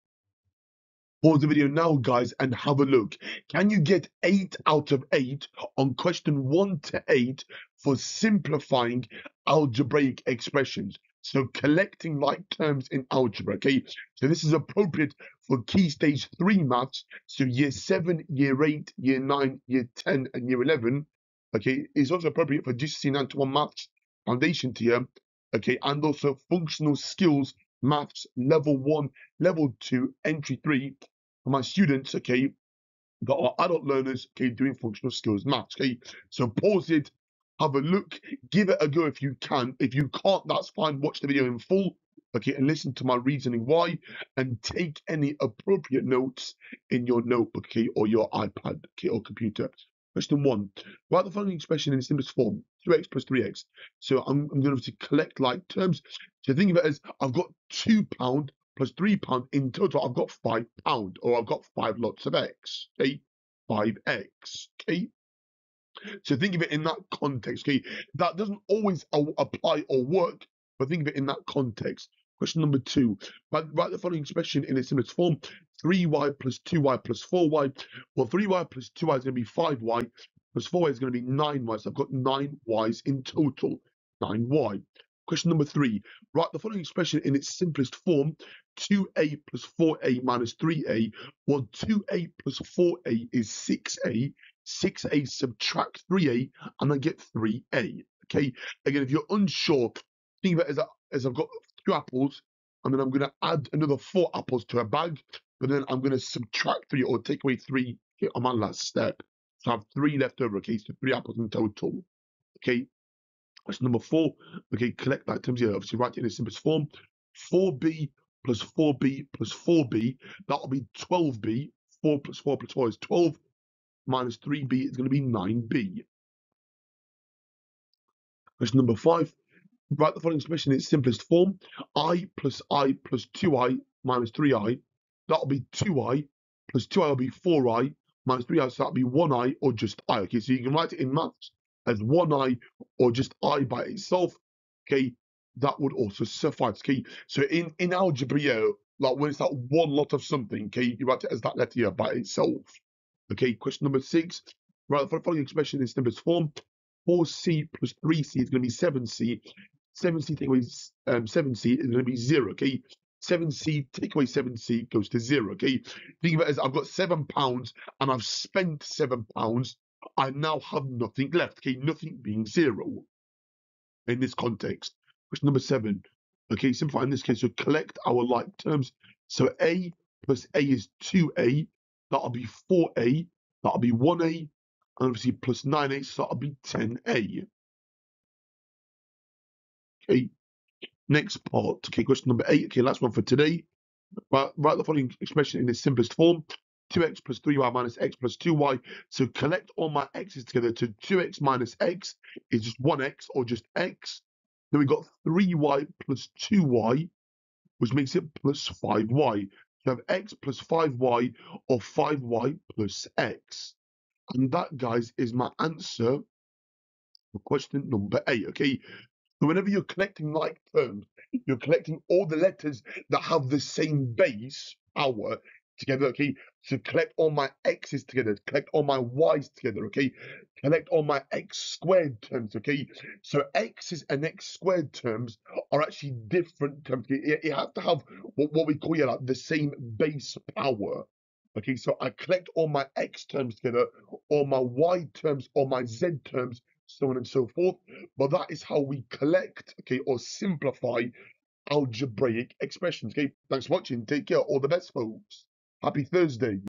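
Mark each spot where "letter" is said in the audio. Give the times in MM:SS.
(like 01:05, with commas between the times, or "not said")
02:31, 03:42.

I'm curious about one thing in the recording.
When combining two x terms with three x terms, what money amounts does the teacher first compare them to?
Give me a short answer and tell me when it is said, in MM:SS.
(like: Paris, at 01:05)
2 pound plus 3 pound, at 00:57.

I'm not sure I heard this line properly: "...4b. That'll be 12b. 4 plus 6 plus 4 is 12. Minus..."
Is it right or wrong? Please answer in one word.
wrong.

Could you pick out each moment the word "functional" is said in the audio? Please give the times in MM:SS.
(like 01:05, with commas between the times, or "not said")
00:26, 00:34.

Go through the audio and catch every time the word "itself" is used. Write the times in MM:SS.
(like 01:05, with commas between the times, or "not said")
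02:23, 02:32.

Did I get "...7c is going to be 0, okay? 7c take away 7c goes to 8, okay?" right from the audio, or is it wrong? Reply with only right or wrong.
wrong.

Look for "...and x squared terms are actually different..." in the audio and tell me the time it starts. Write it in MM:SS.
03:54.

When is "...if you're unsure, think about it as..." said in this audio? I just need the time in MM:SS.
01:39.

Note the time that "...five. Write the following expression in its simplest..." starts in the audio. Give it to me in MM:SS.
02:08.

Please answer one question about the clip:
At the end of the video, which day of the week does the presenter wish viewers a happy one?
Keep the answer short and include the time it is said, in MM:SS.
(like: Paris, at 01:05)
Thursday, at 04:15.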